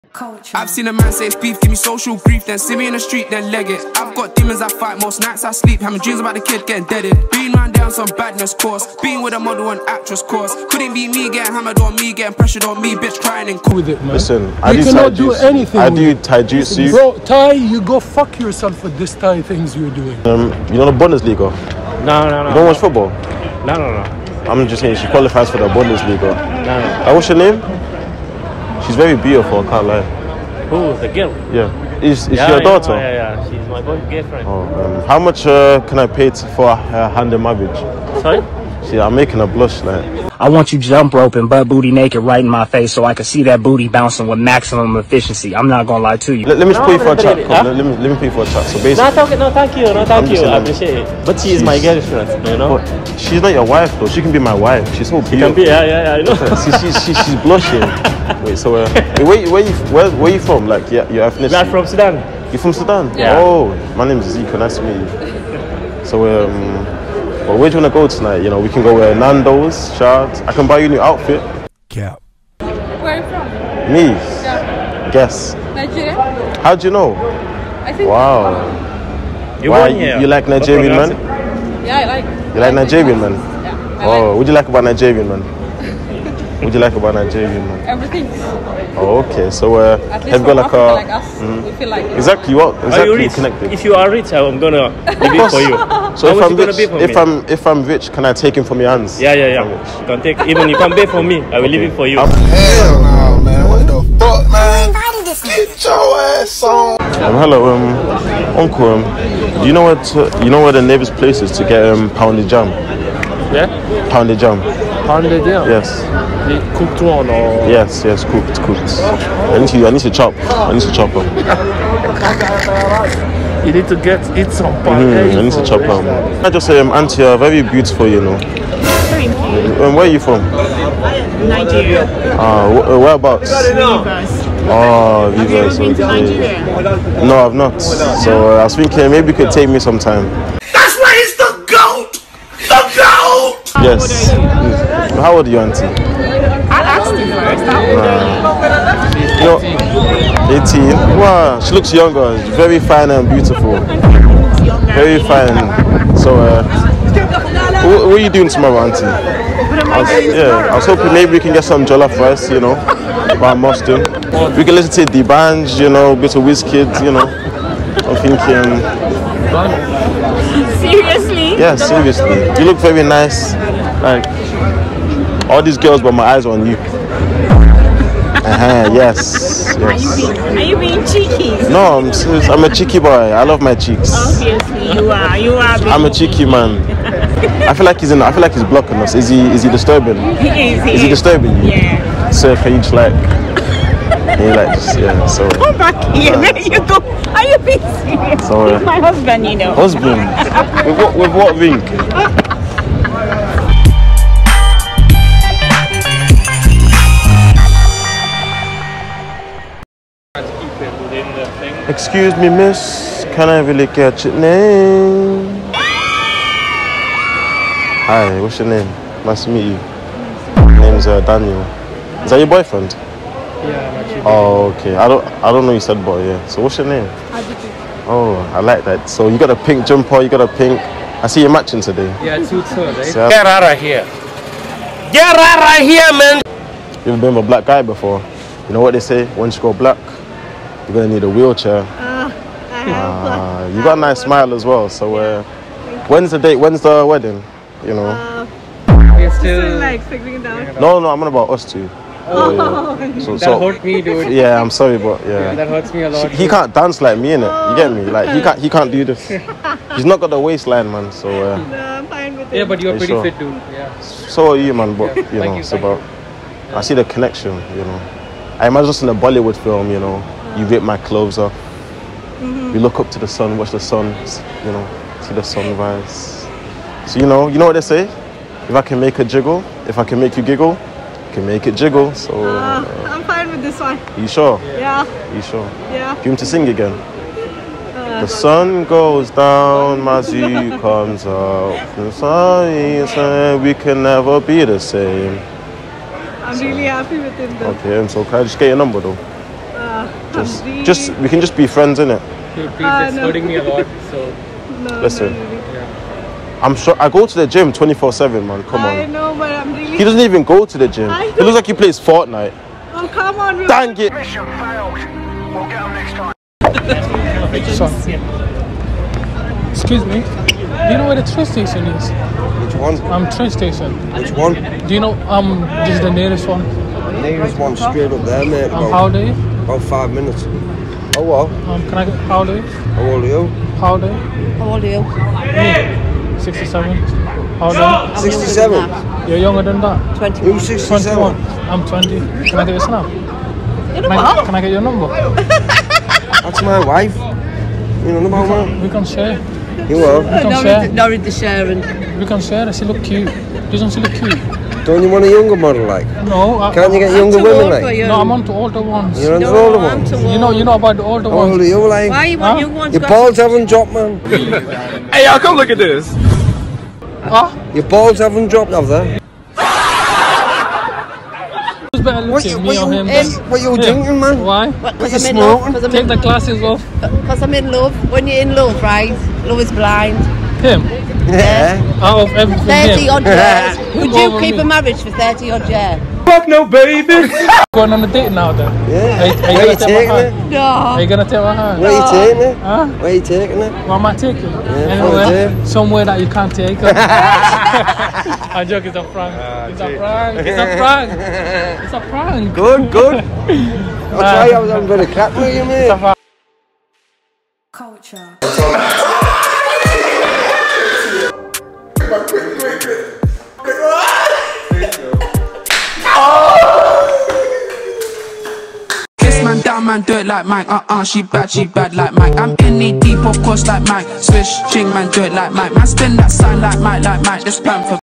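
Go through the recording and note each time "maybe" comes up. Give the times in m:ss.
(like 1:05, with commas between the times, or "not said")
2:19, 2:41.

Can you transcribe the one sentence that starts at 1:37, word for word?
I'm if I'm rich, can I take him from your hands?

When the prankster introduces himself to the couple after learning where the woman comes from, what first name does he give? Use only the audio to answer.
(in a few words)
Zeke.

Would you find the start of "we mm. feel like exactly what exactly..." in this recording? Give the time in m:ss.
1:31.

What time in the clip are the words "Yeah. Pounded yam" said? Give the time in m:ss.
1:53.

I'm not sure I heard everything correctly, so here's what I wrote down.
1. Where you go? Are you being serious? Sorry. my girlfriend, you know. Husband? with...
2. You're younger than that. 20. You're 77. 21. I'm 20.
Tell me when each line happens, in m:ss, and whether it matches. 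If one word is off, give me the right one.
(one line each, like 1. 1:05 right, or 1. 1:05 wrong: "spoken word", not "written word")
1. 3:16 wrong: "husband", not "girlfriend"
2. 5:39 wrong: "67", not "77".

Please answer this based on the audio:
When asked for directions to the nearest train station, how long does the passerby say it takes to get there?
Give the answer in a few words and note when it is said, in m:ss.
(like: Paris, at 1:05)
About 5 minutes, at 5:29.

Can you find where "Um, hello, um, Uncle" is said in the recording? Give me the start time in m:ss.
1:47.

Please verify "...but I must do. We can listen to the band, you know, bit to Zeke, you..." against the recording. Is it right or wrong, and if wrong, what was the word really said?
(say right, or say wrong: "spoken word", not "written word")
wrong: "Wizkid", not "Zeke".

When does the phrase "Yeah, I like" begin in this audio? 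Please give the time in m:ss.
1:21.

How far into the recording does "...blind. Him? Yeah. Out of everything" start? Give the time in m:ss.
6:19.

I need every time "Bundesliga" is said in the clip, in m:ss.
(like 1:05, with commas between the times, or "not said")
0:20, 0:25.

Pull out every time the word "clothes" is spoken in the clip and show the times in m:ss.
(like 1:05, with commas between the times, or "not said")
4:30.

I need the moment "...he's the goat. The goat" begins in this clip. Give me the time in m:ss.
2:21.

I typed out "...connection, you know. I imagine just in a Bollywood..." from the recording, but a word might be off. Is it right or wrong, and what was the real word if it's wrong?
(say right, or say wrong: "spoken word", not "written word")
right.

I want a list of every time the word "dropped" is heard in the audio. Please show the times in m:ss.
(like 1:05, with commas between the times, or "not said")
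6:03, 6:08.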